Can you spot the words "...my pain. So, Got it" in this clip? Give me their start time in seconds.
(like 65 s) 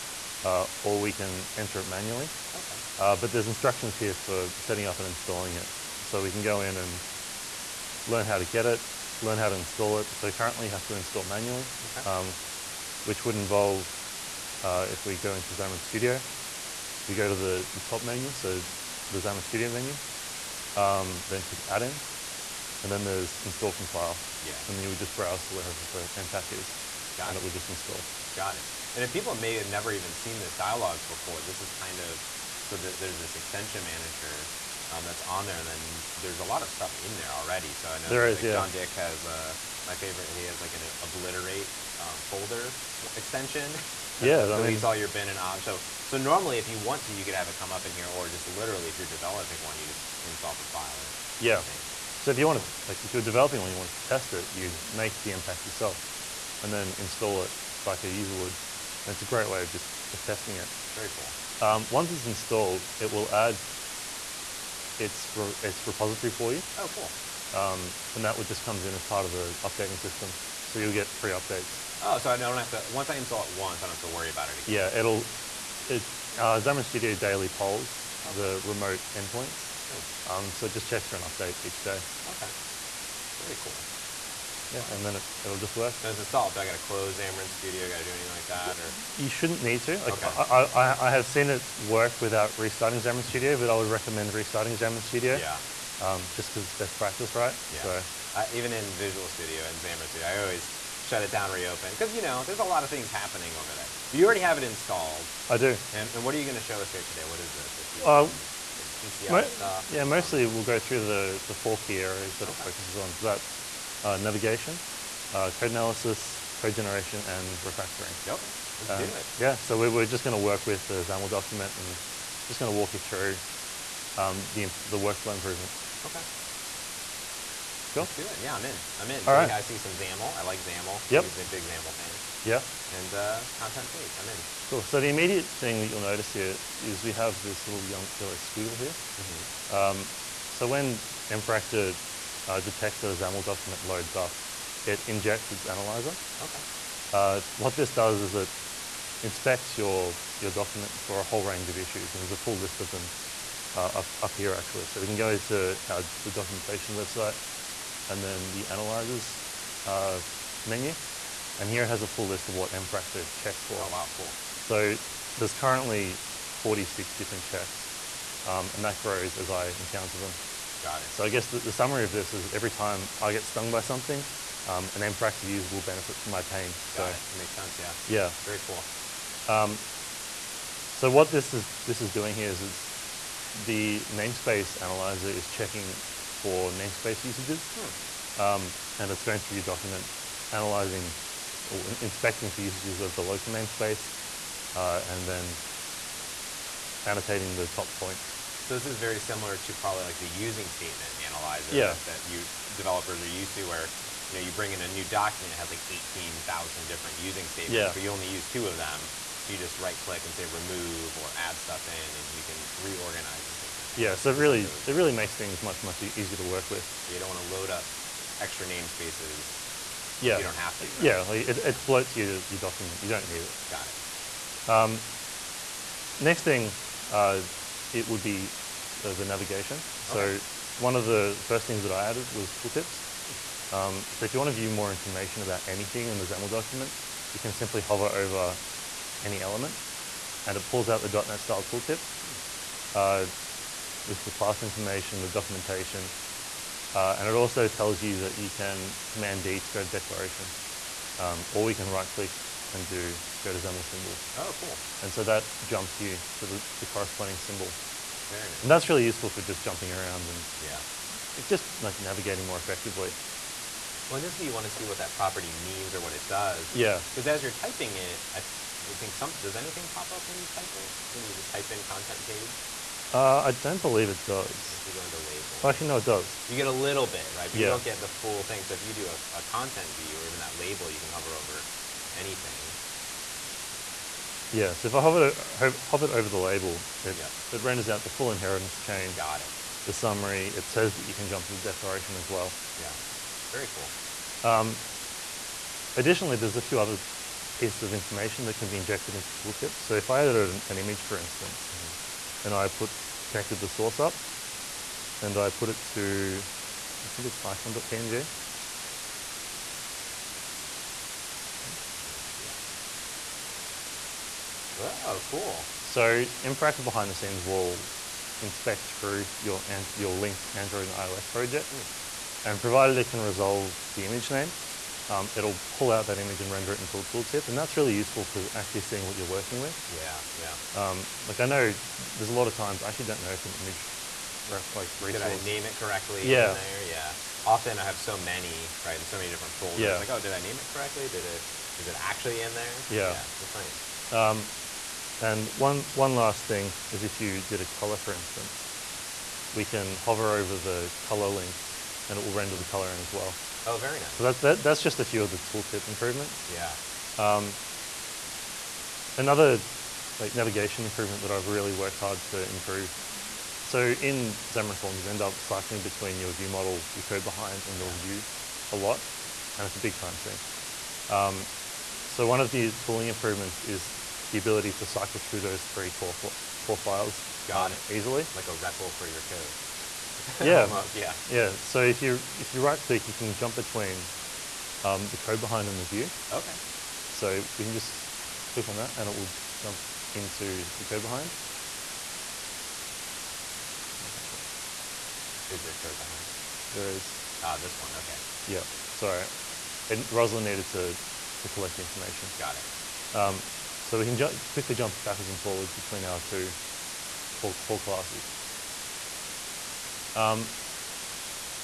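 176 s.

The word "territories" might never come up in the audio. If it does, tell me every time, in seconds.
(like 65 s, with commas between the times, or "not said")
not said.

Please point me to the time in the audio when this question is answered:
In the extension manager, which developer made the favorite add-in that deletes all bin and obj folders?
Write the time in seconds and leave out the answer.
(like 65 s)
38 s.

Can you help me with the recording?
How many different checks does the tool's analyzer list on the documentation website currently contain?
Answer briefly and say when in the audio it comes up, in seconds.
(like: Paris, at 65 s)
46, at 166 s.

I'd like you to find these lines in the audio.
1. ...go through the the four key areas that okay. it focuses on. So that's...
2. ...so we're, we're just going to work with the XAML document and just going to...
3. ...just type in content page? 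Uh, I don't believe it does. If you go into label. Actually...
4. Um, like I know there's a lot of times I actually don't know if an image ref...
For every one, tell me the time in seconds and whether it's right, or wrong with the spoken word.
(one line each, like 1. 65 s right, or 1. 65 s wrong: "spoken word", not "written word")
1. 110 s right
2. 119 s right
3. 271 s right
4. 330 s right.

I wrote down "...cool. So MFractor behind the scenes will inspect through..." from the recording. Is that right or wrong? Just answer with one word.
right.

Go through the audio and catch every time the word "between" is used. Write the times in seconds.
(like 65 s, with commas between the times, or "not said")
365 s, 383 s, 405 s.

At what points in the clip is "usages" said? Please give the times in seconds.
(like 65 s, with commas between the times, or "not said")
187 s, 192 s.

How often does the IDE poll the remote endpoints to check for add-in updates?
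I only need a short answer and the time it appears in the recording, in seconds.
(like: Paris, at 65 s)
Daily, at 77 s.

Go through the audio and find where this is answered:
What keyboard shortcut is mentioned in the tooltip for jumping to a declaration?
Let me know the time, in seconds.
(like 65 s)
249 s.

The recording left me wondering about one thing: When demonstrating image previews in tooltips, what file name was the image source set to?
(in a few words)
icon.png.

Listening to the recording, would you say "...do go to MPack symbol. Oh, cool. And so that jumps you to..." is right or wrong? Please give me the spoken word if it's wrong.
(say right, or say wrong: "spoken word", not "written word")
wrong: "XAML", not "MPack".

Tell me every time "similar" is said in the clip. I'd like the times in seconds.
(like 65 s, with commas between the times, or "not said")
199 s.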